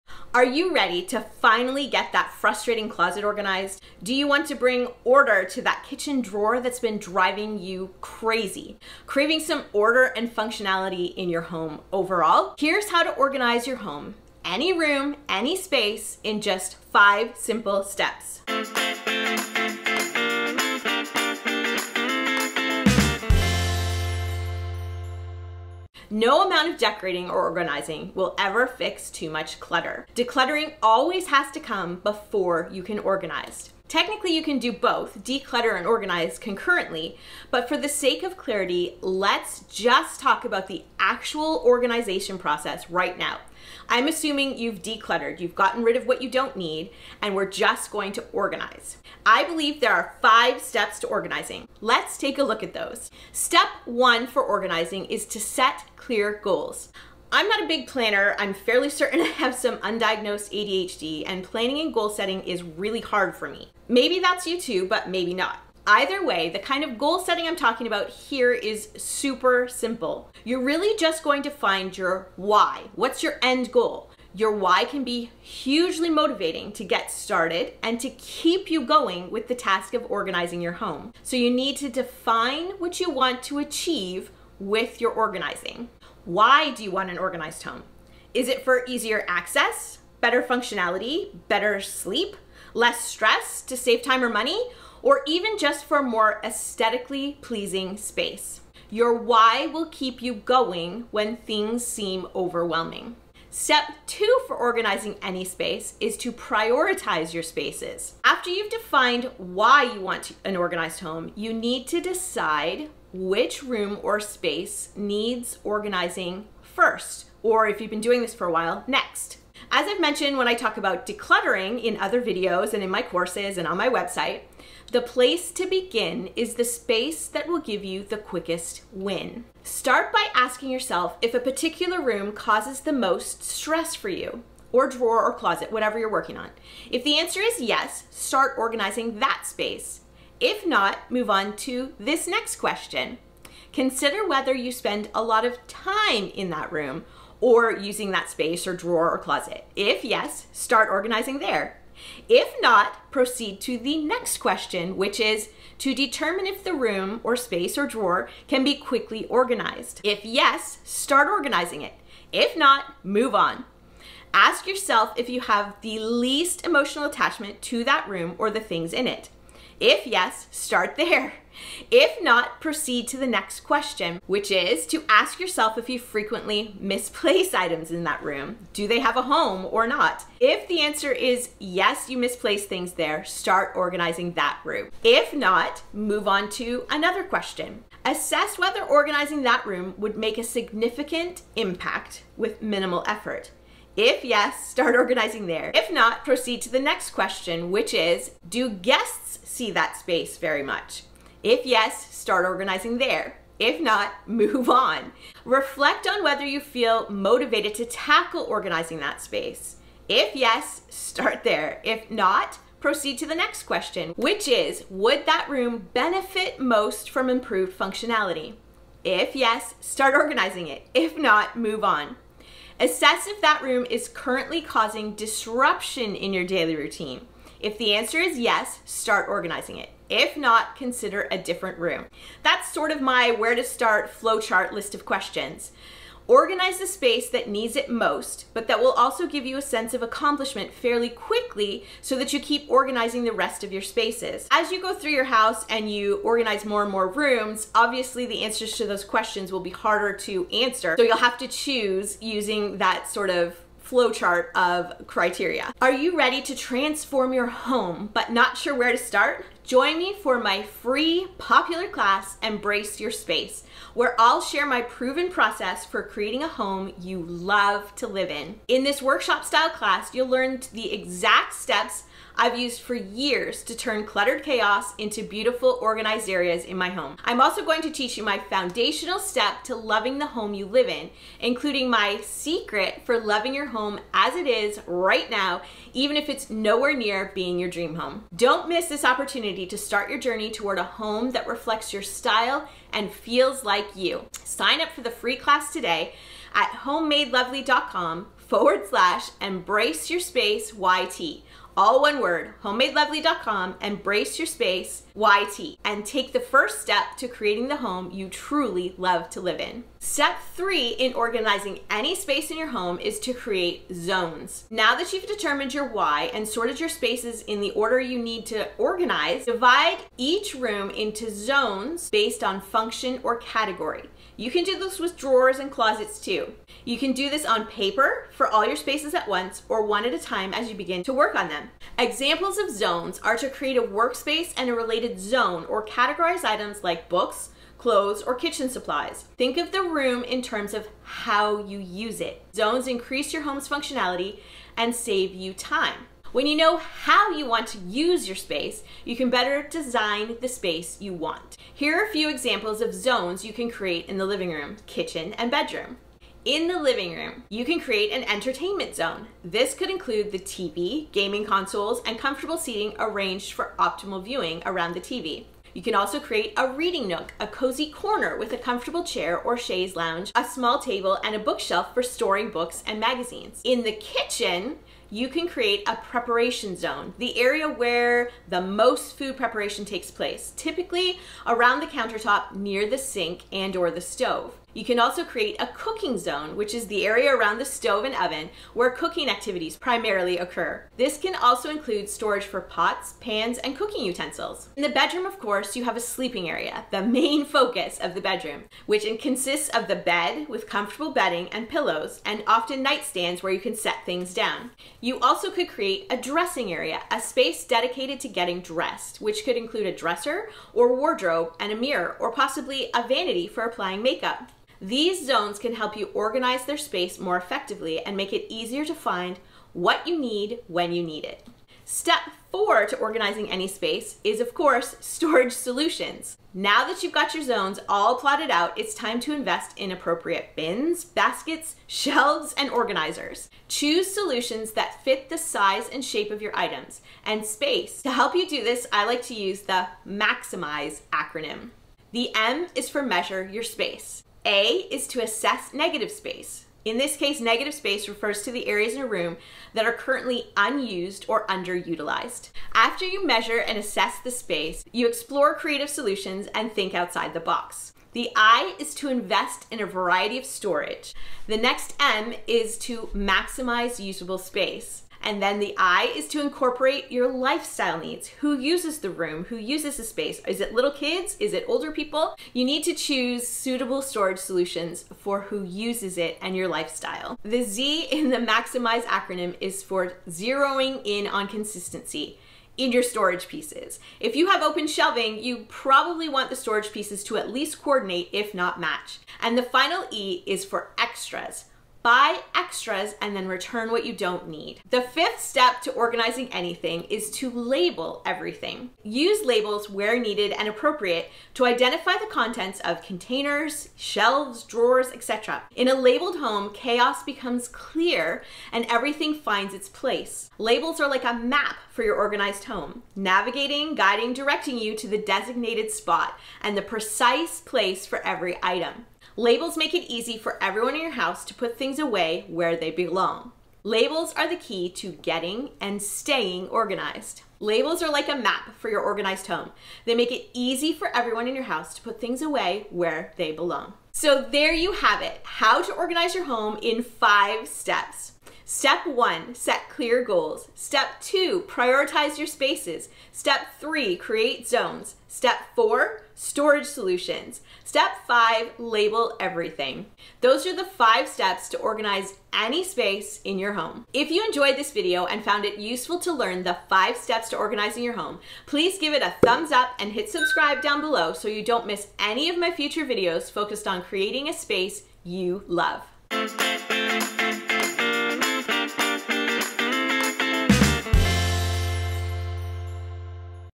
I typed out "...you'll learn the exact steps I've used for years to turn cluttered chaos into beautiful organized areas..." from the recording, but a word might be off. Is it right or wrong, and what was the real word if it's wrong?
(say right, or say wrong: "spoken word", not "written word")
right.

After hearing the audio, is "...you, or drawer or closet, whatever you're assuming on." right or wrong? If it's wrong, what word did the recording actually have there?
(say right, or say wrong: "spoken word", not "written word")
wrong: "working", not "assuming".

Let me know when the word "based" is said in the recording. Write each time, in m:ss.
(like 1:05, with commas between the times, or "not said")
5:22.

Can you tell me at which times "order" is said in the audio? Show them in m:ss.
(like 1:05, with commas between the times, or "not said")
0:05, 0:09, 5:17.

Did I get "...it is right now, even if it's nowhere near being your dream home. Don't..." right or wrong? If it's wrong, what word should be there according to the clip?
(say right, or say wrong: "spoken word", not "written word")
right.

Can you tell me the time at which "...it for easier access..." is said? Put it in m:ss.
1:28.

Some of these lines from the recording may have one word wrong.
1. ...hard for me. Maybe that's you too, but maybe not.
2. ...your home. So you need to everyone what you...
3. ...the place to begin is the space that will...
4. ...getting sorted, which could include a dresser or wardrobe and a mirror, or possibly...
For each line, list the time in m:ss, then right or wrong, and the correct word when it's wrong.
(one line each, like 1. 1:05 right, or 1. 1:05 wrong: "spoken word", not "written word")
1. 1:03 right
2. 1:20 wrong: "define", not "everyone"
3. 2:04 right
4. 6:48 wrong: "dressed", not "sorted".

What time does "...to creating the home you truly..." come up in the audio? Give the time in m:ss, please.
5:07.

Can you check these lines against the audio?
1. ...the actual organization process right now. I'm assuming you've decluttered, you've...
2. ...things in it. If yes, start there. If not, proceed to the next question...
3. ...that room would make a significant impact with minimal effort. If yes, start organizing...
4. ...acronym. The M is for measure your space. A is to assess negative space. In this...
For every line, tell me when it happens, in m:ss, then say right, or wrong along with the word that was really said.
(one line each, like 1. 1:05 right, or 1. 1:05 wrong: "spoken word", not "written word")
1. 0:40 right
2. 2:48 right
3. 3:09 right
4. 7:21 right.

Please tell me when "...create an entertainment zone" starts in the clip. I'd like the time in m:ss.
5:57.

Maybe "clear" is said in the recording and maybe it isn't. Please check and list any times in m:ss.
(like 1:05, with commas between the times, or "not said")
0:55, 8:27, 8:59.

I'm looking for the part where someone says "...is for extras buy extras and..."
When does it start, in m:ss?
8:10.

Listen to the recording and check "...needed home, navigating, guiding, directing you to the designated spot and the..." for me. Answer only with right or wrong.
wrong.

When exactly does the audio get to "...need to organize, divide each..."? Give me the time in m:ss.
5:18.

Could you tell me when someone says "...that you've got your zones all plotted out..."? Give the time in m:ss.
7:06.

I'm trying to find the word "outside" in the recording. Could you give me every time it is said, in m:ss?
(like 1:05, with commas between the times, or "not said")
7:36.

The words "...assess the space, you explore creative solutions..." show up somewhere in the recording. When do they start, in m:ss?
7:33.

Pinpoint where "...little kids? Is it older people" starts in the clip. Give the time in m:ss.
7:50.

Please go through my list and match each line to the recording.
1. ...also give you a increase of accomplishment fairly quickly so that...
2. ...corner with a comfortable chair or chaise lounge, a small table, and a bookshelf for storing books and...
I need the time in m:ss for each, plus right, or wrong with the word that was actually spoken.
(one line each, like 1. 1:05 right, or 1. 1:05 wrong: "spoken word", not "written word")
1. 3:58 wrong: "sense", not "increase"
2. 6:07 right.